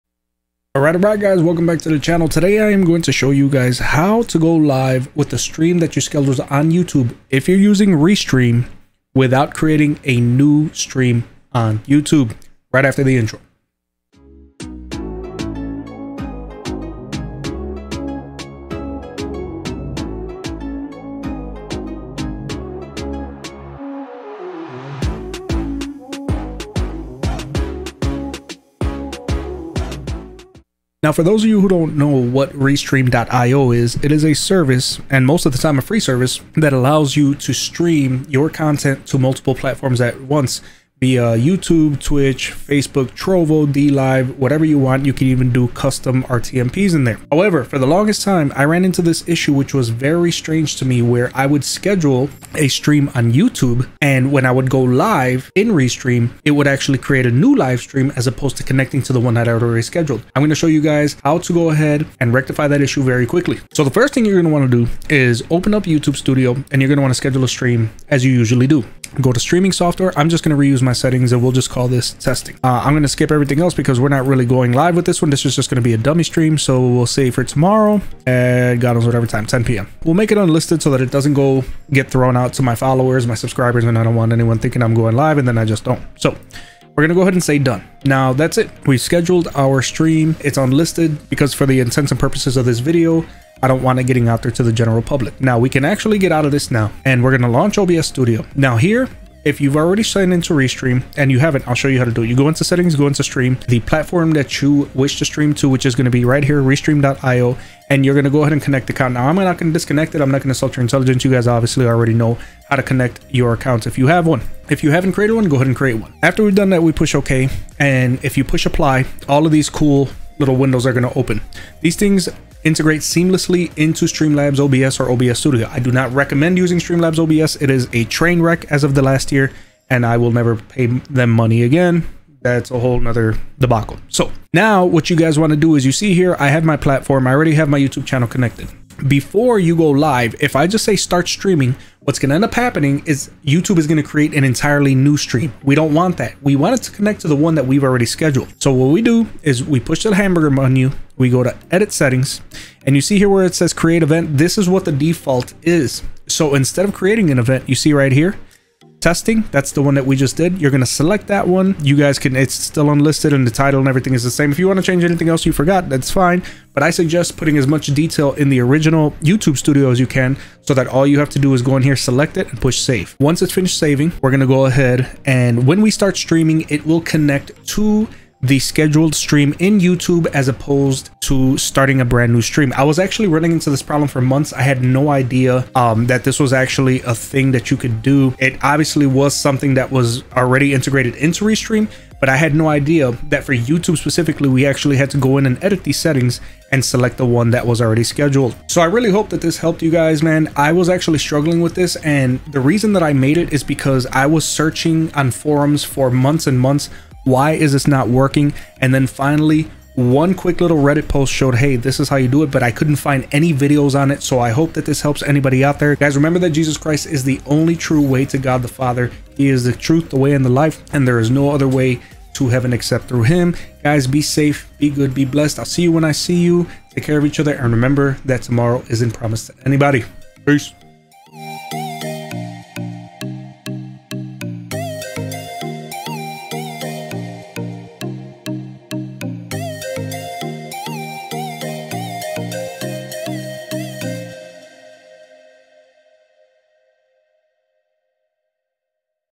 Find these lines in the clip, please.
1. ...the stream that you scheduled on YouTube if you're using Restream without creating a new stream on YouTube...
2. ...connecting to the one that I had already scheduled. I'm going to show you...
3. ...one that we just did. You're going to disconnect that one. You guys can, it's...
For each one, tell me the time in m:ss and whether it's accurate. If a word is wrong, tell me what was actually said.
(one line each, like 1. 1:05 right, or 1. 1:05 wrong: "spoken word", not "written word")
1. 0:05 right
2. 0:58 right
3. 2:39 wrong: "select", not "disconnect".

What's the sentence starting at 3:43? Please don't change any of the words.
Guys, be safe, be good, be blessed.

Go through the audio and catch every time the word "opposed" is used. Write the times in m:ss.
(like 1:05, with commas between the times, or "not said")
0:58, 3:00.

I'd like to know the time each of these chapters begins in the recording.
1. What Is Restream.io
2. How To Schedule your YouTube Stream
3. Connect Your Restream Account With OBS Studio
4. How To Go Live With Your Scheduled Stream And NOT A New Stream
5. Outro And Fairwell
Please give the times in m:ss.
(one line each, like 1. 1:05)
1. 0:31
2. 0:49
3. 1:38
4. 2:31
5. 3:19.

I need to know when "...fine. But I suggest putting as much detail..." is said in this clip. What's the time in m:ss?
2:46.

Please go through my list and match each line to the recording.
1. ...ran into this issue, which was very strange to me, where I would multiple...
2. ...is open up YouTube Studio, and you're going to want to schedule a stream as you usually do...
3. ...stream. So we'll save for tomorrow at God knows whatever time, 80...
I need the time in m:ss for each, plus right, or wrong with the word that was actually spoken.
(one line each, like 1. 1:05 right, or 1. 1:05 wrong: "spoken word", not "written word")
1. 0:48 wrong: "schedule", not "multiple"
2. 1:05 right
3. 1:16 wrong: "10", not "80".